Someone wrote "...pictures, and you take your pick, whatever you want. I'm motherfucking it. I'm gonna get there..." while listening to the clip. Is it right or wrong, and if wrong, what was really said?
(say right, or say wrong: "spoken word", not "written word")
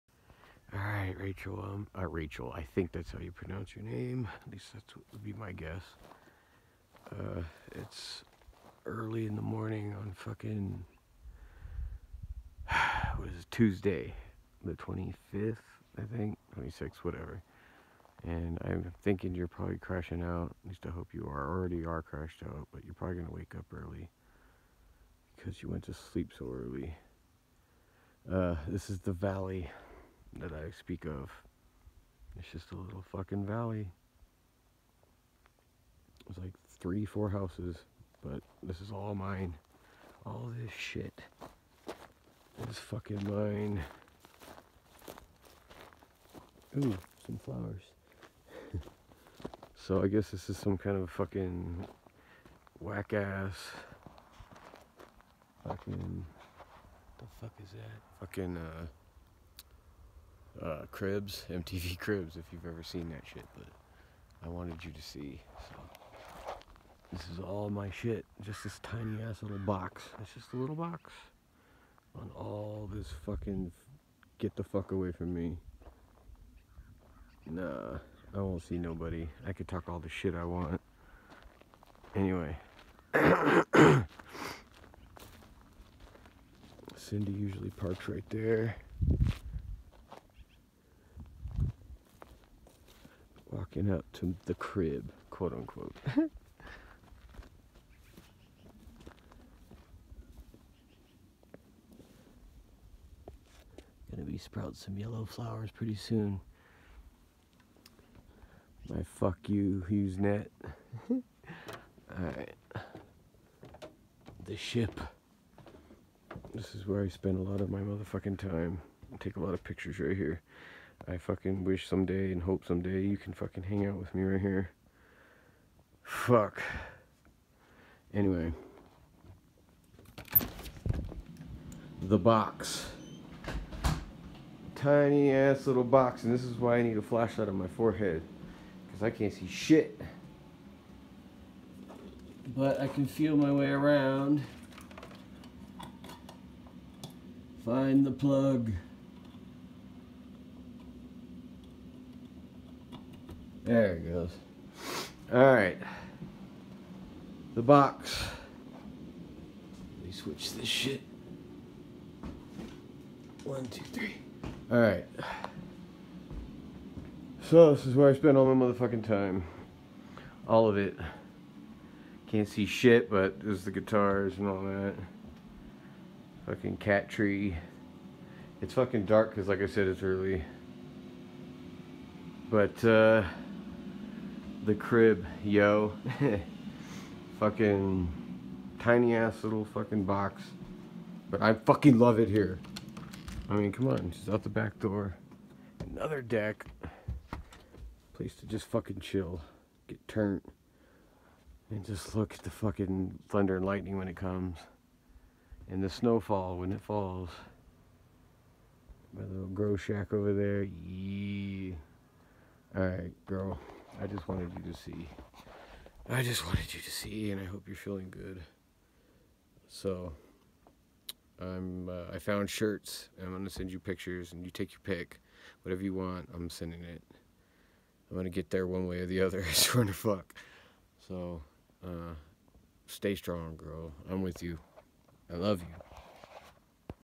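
wrong: "sending", not "motherfucking".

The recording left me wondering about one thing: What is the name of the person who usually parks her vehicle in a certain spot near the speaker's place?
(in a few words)
Cindy.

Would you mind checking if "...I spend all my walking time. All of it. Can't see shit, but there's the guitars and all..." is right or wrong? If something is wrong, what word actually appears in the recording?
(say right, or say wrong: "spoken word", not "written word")
wrong: "motherfucking", not "walking".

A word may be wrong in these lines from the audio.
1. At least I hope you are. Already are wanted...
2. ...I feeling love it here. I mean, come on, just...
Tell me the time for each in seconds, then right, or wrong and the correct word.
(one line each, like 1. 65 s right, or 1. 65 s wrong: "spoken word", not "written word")
1. 20 s wrong: "crashed", not "wanted"
2. 191 s wrong: "fucking", not "feeling".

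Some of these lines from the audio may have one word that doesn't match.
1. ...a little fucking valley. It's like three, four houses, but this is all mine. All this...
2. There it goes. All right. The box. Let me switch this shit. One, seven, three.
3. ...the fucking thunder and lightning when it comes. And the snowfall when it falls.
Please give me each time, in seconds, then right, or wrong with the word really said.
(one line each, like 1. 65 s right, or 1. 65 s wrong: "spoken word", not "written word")
1. 32 s right
2. 153 s wrong: "two", not "seven"
3. 202 s right.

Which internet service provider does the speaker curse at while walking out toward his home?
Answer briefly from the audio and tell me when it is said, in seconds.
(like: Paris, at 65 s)
HughesNet, at 109 s.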